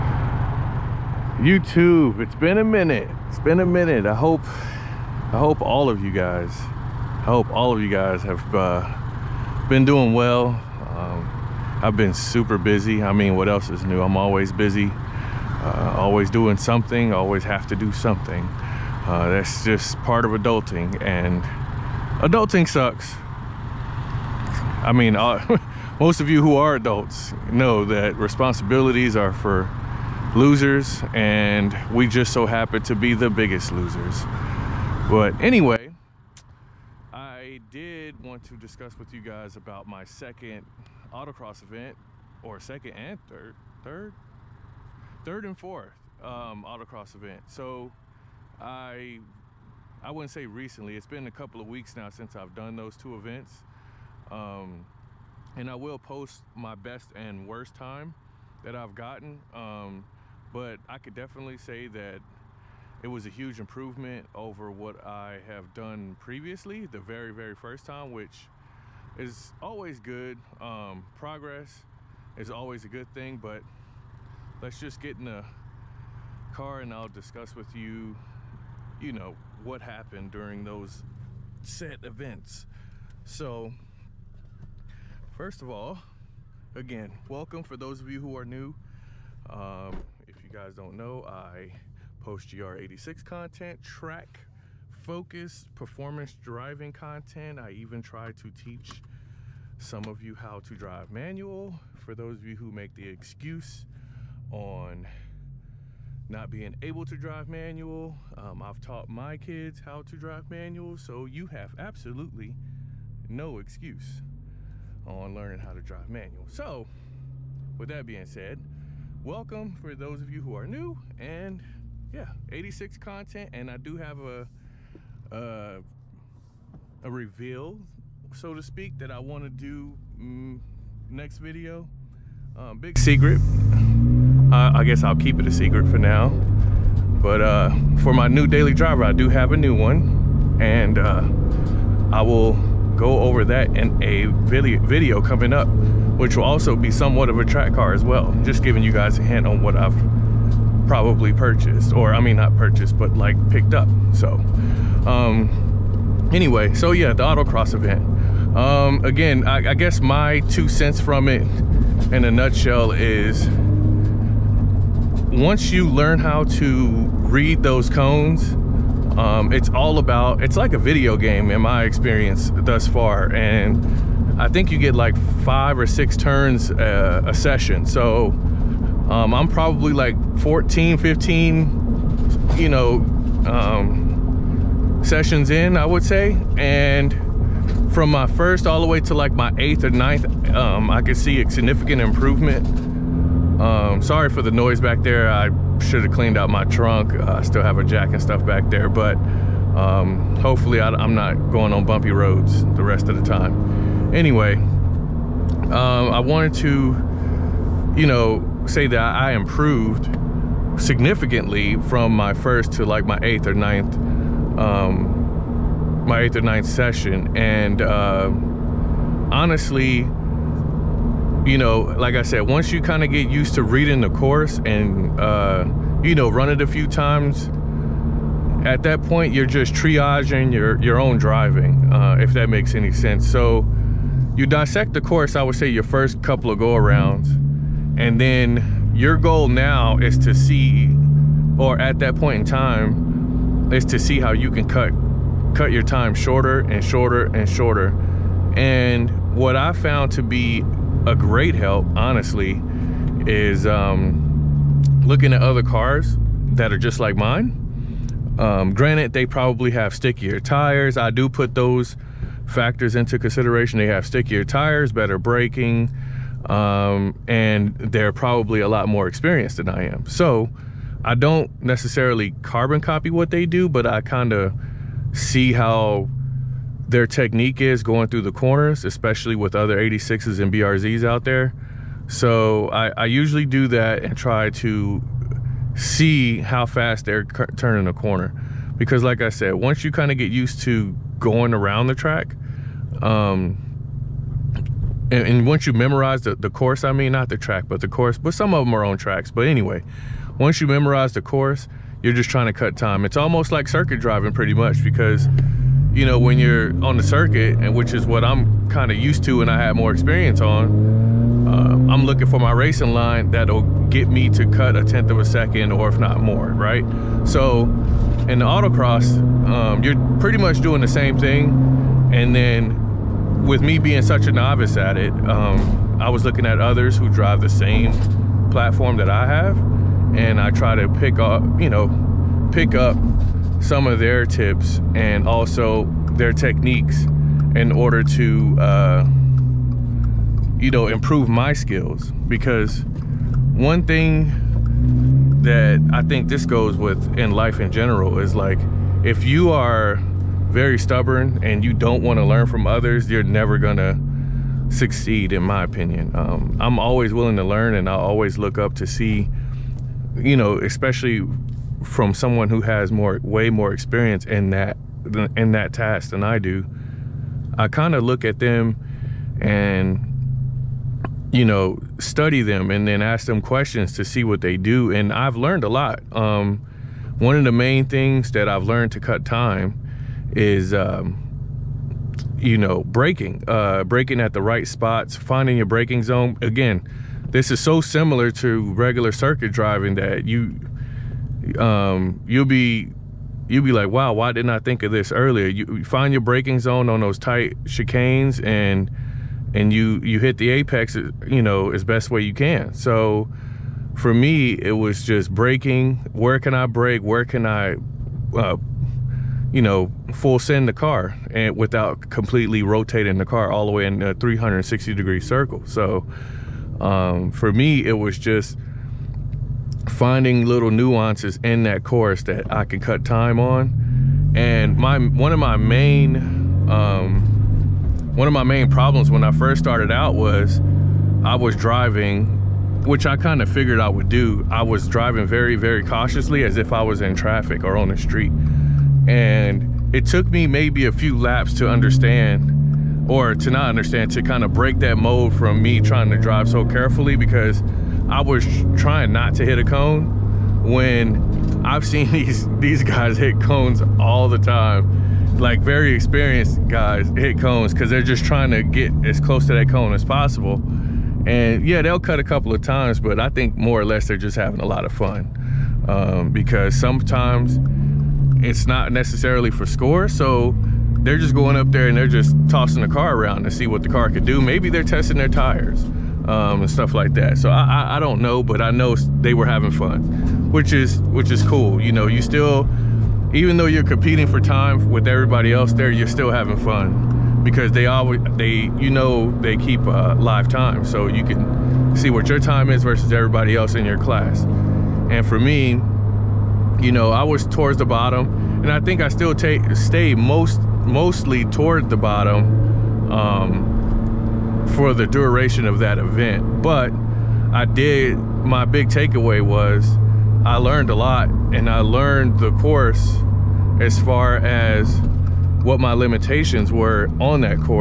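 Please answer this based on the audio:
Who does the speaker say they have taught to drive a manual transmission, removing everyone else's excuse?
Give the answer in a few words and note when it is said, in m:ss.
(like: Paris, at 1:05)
my kids, at 1:49.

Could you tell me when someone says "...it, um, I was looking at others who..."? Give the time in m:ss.
5:24.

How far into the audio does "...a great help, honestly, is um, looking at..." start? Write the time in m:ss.
4:11.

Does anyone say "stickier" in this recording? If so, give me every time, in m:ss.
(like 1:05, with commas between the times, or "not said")
4:19, 4:24.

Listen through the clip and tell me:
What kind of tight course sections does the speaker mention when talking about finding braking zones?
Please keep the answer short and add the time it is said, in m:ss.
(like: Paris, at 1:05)
chicanes, at 6:37.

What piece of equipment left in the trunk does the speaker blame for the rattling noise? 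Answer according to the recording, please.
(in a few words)
a jack.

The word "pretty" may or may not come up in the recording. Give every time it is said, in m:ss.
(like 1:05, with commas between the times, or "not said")
5:04, 5:20.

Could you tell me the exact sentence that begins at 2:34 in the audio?
So, um, anyway, so yeah, the autocross event.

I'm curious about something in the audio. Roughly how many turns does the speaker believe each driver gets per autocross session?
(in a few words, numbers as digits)
5 or 6.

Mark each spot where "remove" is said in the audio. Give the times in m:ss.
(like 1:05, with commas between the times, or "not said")
not said.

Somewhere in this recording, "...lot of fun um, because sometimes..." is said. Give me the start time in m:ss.
7:44.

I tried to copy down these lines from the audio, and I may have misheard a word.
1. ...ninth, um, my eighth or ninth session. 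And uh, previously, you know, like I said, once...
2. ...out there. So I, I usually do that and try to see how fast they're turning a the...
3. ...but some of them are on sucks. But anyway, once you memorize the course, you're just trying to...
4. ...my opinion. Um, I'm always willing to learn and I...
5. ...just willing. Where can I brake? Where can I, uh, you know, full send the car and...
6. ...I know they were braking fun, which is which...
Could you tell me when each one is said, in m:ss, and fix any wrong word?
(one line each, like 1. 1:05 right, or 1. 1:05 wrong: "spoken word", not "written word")
1. 3:33 wrong: "honestly", not "previously"
2. 4:41 right
3. 4:58 wrong: "tracks", not "sucks"
4. 5:55 right
5. 6:45 wrong: "braking", not "willing"
6. 7:58 wrong: "having", not "braking".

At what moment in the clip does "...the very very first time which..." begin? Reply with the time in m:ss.
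1:06.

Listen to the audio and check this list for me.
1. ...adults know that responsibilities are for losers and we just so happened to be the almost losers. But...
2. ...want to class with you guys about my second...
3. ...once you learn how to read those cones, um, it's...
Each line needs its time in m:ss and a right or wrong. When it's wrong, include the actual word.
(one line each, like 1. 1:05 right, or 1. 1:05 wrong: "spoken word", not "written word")
1. 0:26 wrong: "biggest", not "almost"
2. 0:38 wrong: "discuss", not "class"
3. 2:45 right.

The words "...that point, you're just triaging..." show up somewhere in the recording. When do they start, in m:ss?
3:48.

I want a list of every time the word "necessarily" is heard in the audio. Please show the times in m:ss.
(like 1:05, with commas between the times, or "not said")
4:31, 7:48.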